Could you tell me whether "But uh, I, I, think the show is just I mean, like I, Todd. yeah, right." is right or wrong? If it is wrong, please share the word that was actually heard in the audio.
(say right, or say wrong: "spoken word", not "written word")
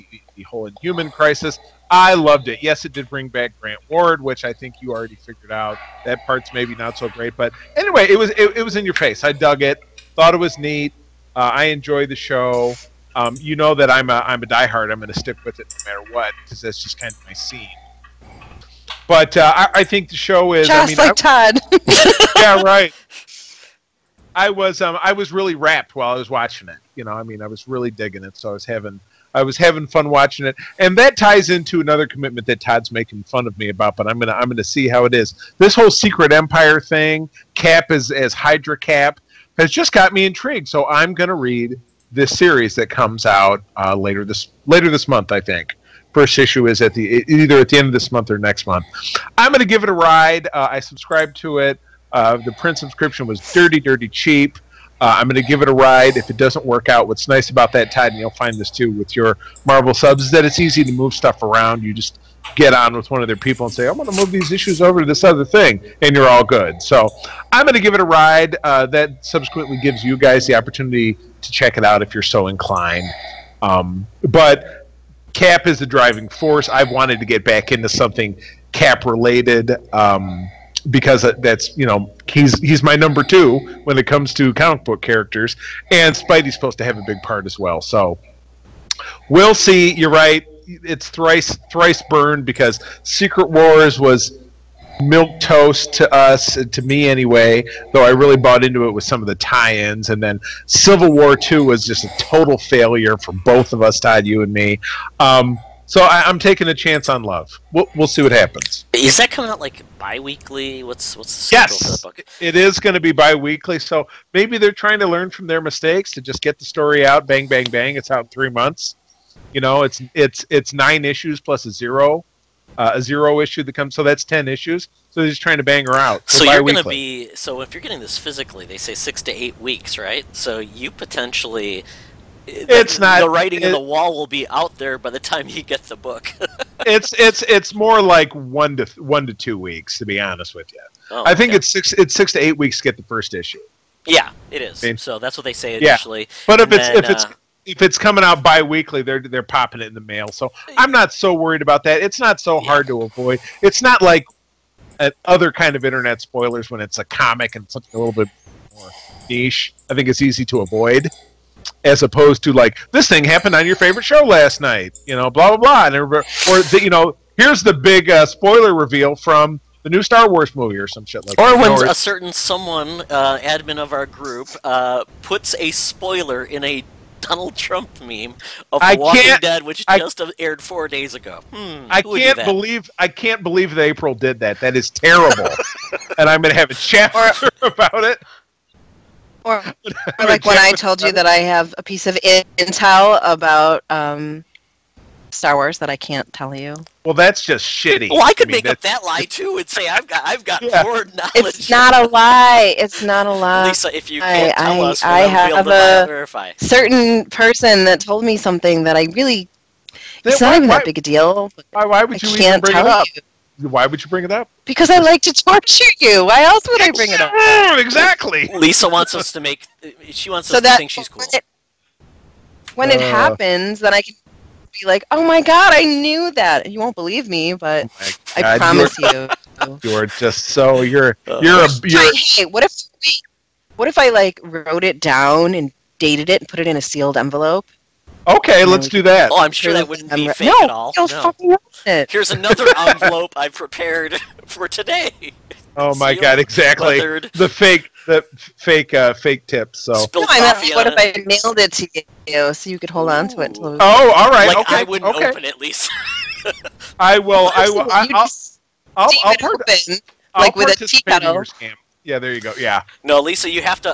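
right.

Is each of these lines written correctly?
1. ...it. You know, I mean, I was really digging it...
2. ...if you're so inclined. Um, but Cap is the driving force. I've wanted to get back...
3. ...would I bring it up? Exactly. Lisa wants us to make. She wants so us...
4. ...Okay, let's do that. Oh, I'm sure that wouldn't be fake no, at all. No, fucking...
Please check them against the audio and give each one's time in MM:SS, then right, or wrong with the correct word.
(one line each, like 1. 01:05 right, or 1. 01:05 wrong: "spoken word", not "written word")
1. 00:26 right
2. 01:12 right
3. 03:36 right
4. 03:58 right.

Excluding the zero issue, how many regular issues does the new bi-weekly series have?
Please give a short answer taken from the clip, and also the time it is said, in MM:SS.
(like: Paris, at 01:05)
9, at 02:00.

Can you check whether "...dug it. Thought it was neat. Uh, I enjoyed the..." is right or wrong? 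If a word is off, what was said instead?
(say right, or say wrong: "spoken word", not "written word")
right.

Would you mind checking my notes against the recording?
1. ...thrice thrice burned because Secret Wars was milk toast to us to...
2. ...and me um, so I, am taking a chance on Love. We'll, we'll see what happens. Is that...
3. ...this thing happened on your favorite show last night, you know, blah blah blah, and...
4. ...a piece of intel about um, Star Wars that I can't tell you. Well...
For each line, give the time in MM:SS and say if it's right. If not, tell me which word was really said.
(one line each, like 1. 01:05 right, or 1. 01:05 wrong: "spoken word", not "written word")
1. 01:31 right
2. 01:44 right
3. 02:42 right
4. 03:11 right.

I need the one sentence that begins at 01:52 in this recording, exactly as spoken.
it is going to be bi-weekly.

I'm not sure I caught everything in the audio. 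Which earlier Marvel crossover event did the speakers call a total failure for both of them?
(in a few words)
Civil War 2.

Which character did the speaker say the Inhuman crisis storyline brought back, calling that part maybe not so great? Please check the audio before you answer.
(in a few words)
Grant Ward.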